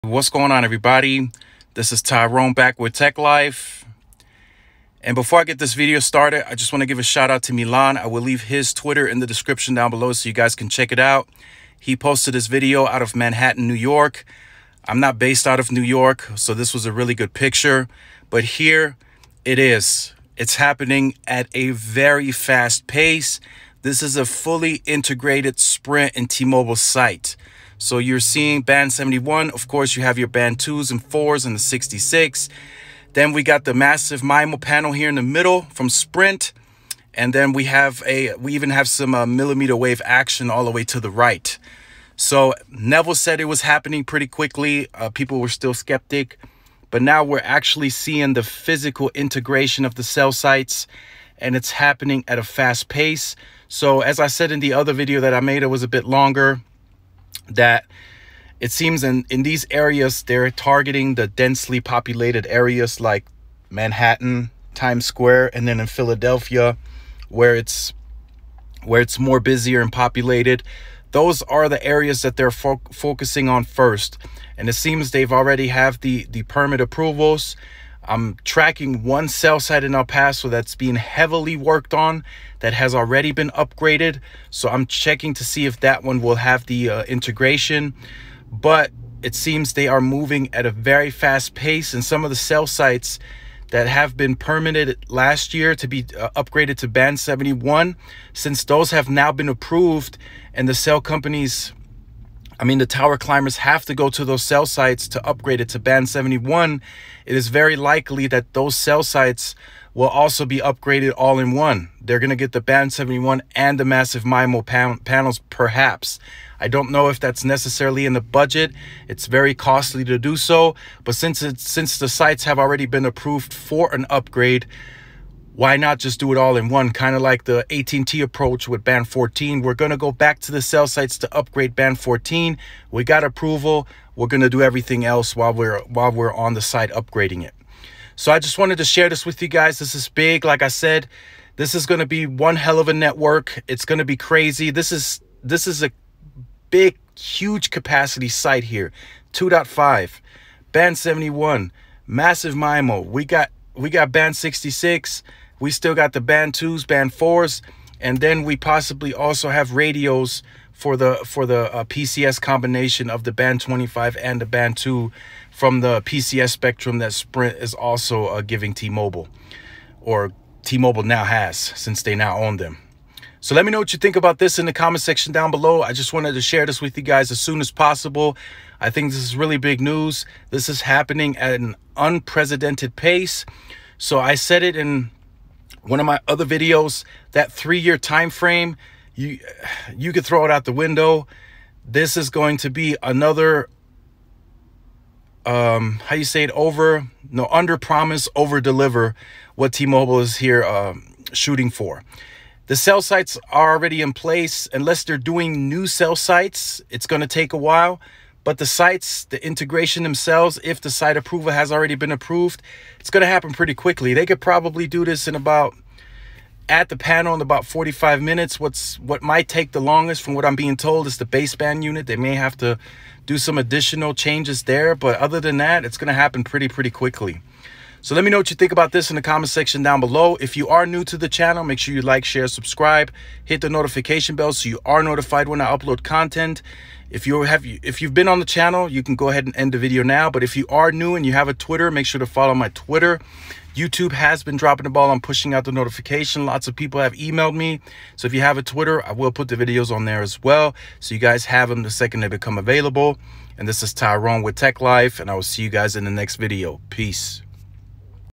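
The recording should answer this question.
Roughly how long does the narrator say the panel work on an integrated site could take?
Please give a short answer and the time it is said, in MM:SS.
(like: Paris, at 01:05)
45 minutes, at 03:37.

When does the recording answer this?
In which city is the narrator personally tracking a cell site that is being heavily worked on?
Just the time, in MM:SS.
01:19.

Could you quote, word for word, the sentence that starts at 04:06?
Lots of people have emailed me.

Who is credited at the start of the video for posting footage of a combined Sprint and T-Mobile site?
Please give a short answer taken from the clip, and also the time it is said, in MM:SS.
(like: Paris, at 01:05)
Milan, at 00:07.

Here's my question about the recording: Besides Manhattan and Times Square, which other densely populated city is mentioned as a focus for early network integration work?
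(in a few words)
Philadelphia.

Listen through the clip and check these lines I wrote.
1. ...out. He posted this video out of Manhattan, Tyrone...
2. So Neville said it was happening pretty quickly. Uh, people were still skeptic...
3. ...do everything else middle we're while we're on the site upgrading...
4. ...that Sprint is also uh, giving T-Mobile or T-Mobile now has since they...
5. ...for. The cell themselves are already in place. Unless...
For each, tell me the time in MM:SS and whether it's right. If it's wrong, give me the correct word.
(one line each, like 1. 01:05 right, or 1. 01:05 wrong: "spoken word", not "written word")
1. 00:10 wrong: "New", not "Tyrone"
2. 00:42 right
3. 02:14 wrong: "while", not "middle"
4. 02:46 right
5. 03:21 wrong: "sites", not "themselves".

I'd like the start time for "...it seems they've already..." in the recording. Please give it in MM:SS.
01:14.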